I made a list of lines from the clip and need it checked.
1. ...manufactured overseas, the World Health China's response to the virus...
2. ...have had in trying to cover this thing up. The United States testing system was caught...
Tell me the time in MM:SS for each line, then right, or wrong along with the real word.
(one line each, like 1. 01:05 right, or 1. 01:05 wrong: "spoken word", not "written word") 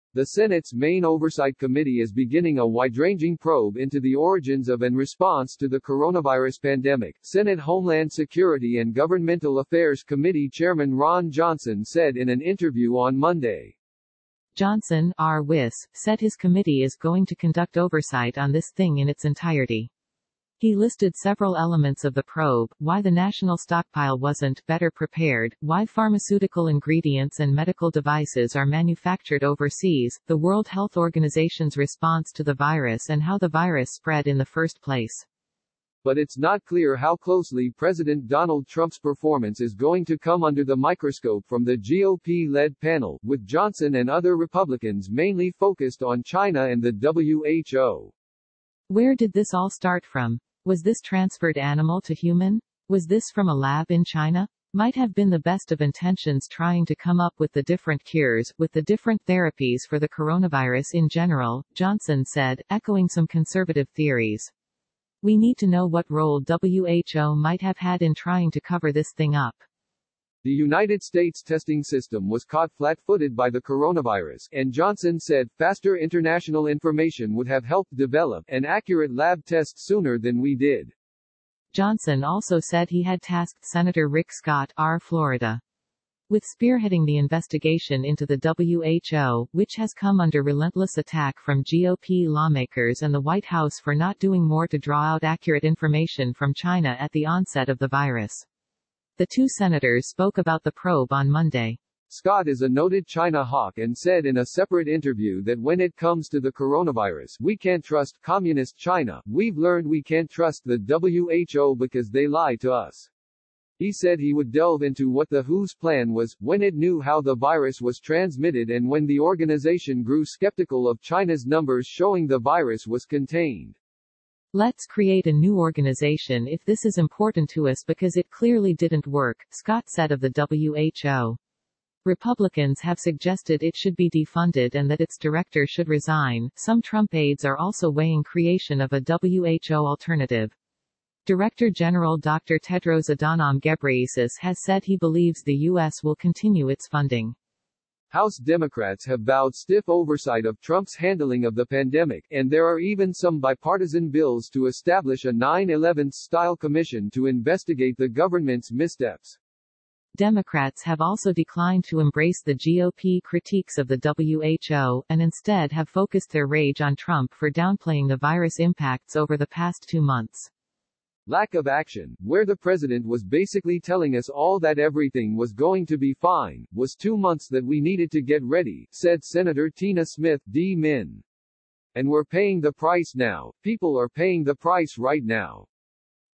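1. 00:28 wrong: "Organization", not "China"
2. 01:07 right.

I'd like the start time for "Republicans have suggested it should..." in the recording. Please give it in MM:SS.
02:12.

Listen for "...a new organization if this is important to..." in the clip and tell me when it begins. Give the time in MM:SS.
02:05.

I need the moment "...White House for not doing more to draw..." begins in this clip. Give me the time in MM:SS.
01:33.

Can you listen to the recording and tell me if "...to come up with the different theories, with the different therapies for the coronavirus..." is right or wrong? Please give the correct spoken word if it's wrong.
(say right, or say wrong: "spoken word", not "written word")
wrong: "cures", not "theories".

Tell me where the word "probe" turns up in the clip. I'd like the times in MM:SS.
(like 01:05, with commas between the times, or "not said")
00:03, 00:22, 01:40.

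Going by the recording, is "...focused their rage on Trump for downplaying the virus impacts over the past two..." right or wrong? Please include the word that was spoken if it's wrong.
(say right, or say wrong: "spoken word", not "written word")
right.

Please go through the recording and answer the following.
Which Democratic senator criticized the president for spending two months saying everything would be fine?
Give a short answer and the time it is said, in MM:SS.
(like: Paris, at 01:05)
Tina Smith, at 02:59.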